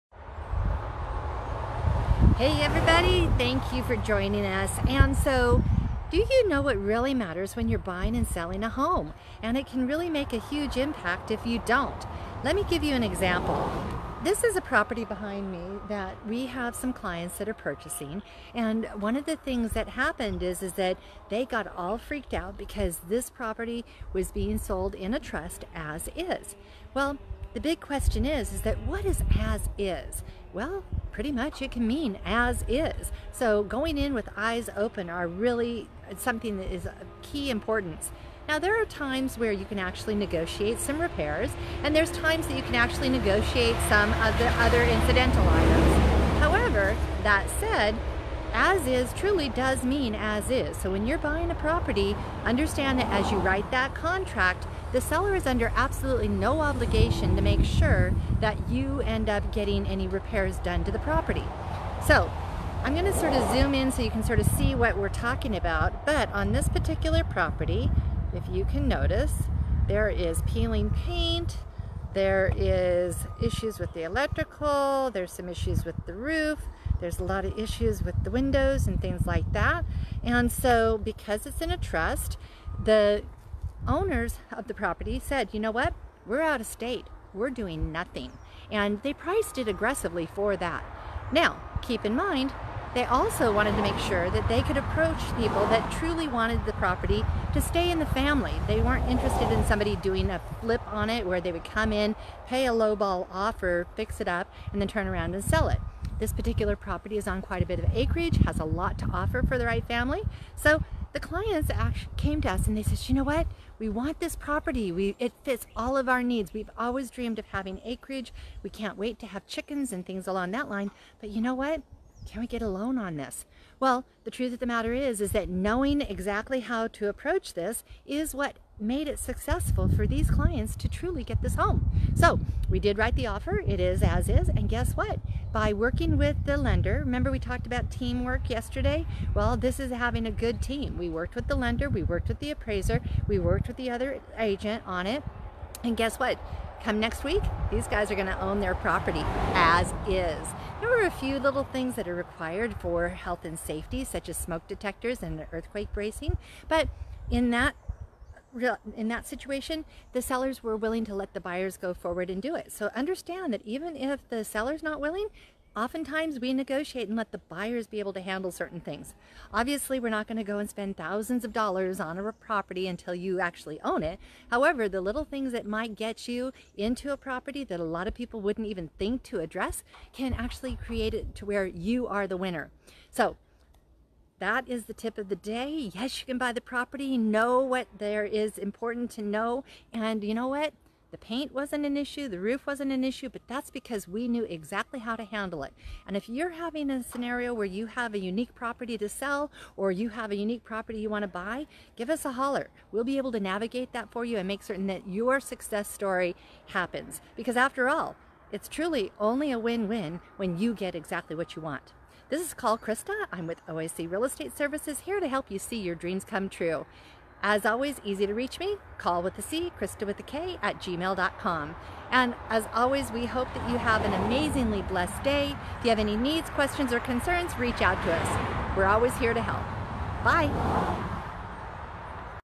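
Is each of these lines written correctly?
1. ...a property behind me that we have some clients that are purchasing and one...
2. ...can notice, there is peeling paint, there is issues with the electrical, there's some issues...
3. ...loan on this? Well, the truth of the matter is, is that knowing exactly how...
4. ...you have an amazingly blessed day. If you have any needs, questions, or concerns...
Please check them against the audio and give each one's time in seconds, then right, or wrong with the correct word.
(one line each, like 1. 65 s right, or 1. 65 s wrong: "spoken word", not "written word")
1. 14 s right
2. 68 s right
3. 122 s right
4. 223 s right.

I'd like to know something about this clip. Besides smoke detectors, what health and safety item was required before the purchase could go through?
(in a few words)
Earthquake bracing.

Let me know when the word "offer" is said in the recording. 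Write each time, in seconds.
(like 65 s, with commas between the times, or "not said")
103 s, 109 s, 133 s.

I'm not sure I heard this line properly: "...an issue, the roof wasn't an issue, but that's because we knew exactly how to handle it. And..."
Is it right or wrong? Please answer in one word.
right.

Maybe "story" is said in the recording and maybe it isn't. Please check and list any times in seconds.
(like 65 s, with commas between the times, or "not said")
205 s.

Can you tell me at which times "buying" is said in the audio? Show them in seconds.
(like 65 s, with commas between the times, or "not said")
7 s, 51 s.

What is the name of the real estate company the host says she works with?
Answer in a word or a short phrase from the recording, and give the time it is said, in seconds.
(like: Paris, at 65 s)
OAC Real Estate Services, at 213 s.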